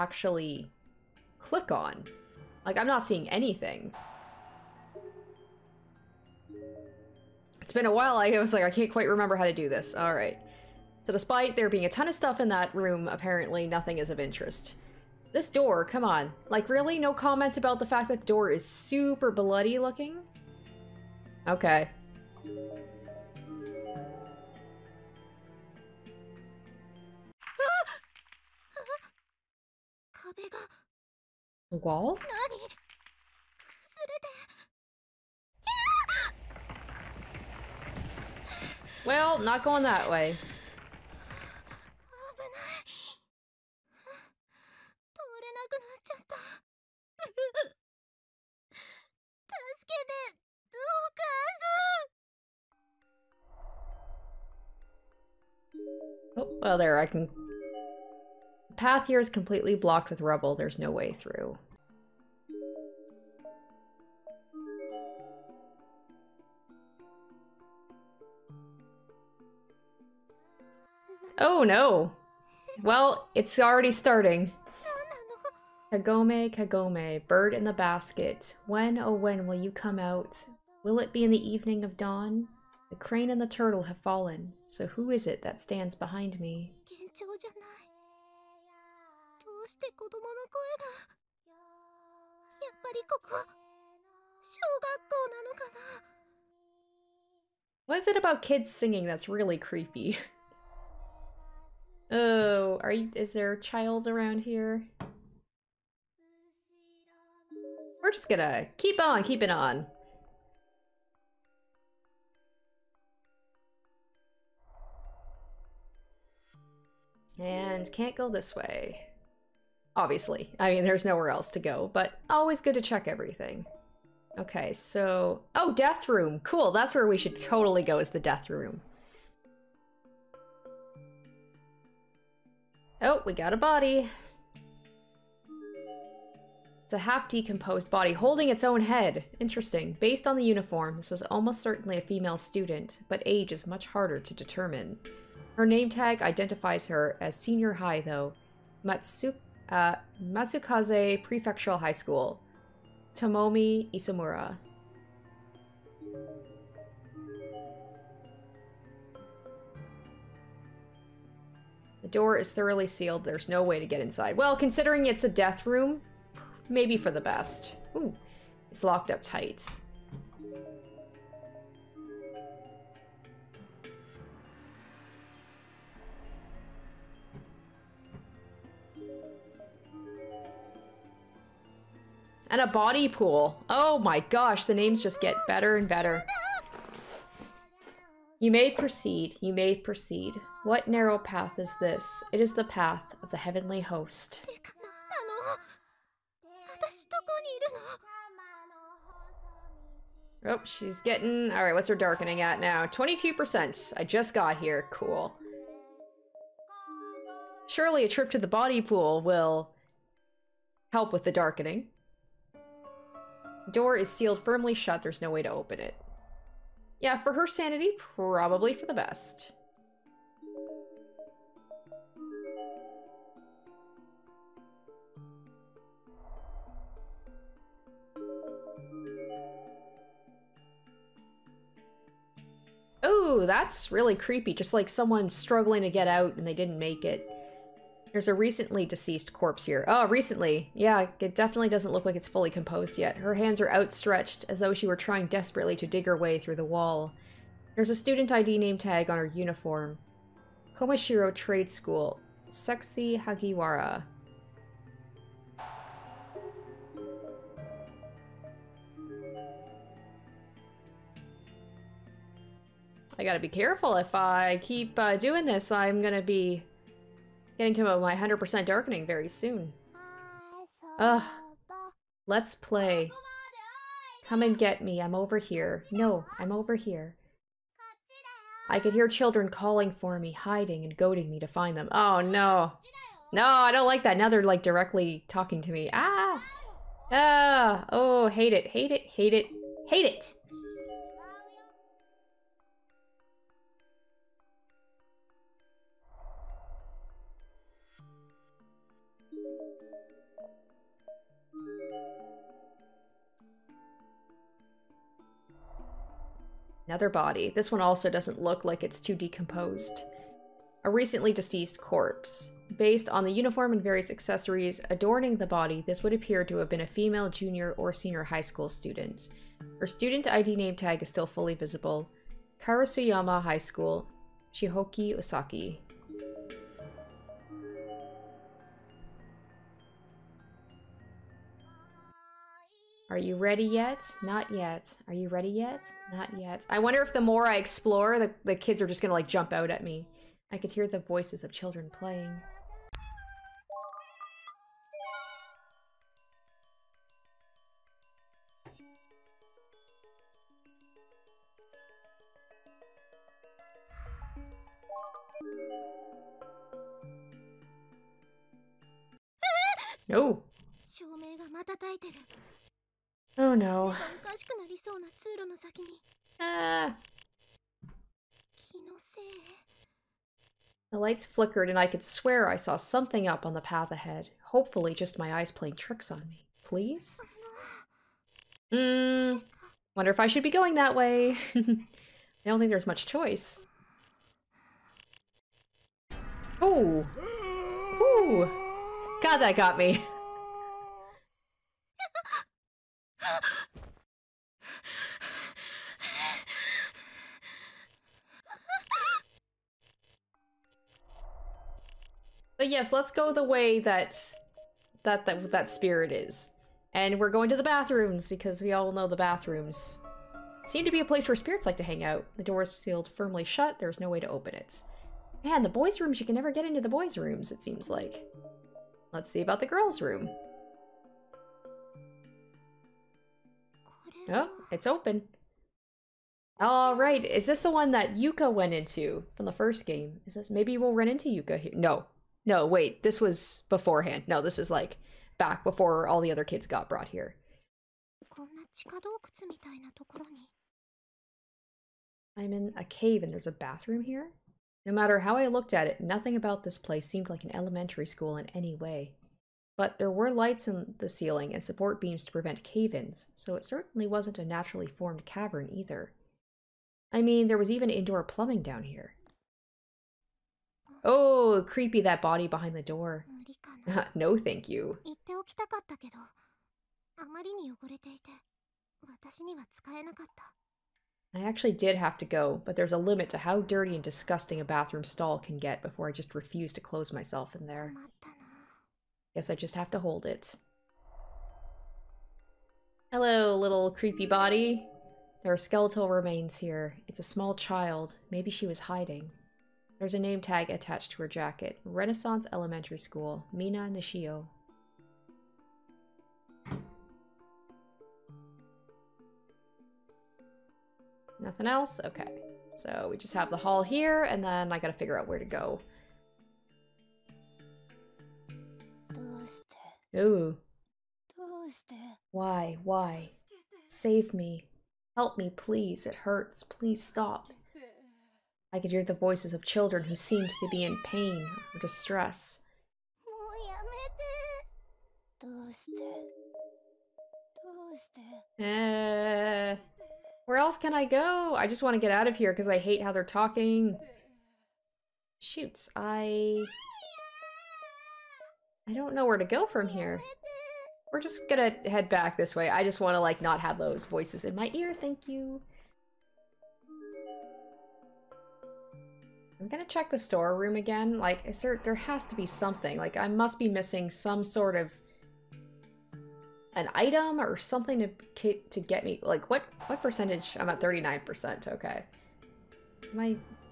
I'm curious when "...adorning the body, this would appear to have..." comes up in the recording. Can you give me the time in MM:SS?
05:14.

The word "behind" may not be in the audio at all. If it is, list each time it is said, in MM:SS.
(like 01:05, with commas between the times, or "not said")
01:25, 07:42.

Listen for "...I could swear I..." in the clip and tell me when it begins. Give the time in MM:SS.
06:11.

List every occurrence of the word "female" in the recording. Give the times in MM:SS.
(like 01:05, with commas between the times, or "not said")
02:22, 05:16.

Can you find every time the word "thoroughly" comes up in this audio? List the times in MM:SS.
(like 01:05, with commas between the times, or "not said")
02:42.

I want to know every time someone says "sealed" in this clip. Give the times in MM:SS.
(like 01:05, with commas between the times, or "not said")
02:42, 03:34, 06:52.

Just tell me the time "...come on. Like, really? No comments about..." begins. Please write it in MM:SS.
00:15.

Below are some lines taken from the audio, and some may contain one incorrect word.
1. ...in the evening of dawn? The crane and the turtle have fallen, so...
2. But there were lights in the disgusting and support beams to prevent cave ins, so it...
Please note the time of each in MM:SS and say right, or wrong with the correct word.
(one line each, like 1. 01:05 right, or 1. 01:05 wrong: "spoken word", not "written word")
1. 01:21 right
2. 07:29 wrong: "ceiling", not "disgusting".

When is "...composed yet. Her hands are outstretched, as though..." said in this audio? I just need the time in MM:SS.
04:02.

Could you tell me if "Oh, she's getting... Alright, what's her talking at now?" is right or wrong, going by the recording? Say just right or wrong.
wrong.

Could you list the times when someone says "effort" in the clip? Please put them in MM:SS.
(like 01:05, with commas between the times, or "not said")
not said.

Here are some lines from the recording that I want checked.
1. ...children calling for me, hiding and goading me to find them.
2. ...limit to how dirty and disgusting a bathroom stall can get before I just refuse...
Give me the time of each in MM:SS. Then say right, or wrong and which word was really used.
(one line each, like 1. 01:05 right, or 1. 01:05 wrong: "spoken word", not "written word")
1. 04:39 right
2. 07:52 right.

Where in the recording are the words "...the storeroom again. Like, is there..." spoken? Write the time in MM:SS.
09:10.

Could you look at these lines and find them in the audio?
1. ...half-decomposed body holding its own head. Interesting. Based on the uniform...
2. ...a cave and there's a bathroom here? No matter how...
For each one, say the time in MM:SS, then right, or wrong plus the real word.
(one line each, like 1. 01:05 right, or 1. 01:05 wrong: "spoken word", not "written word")
1. 02:16 right
2. 07:22 right.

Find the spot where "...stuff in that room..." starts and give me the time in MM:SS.
00:12.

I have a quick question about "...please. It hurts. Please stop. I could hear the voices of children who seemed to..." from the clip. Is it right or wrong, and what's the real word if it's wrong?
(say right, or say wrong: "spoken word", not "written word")
right.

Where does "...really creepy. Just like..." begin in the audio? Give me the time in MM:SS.
03:53.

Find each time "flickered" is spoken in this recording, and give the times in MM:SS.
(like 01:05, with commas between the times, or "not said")
06:11.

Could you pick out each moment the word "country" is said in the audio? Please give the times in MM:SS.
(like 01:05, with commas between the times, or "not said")
not said.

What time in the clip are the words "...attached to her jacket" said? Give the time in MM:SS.
08:10.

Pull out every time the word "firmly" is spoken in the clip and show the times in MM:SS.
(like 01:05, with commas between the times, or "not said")
03:34, 06:53.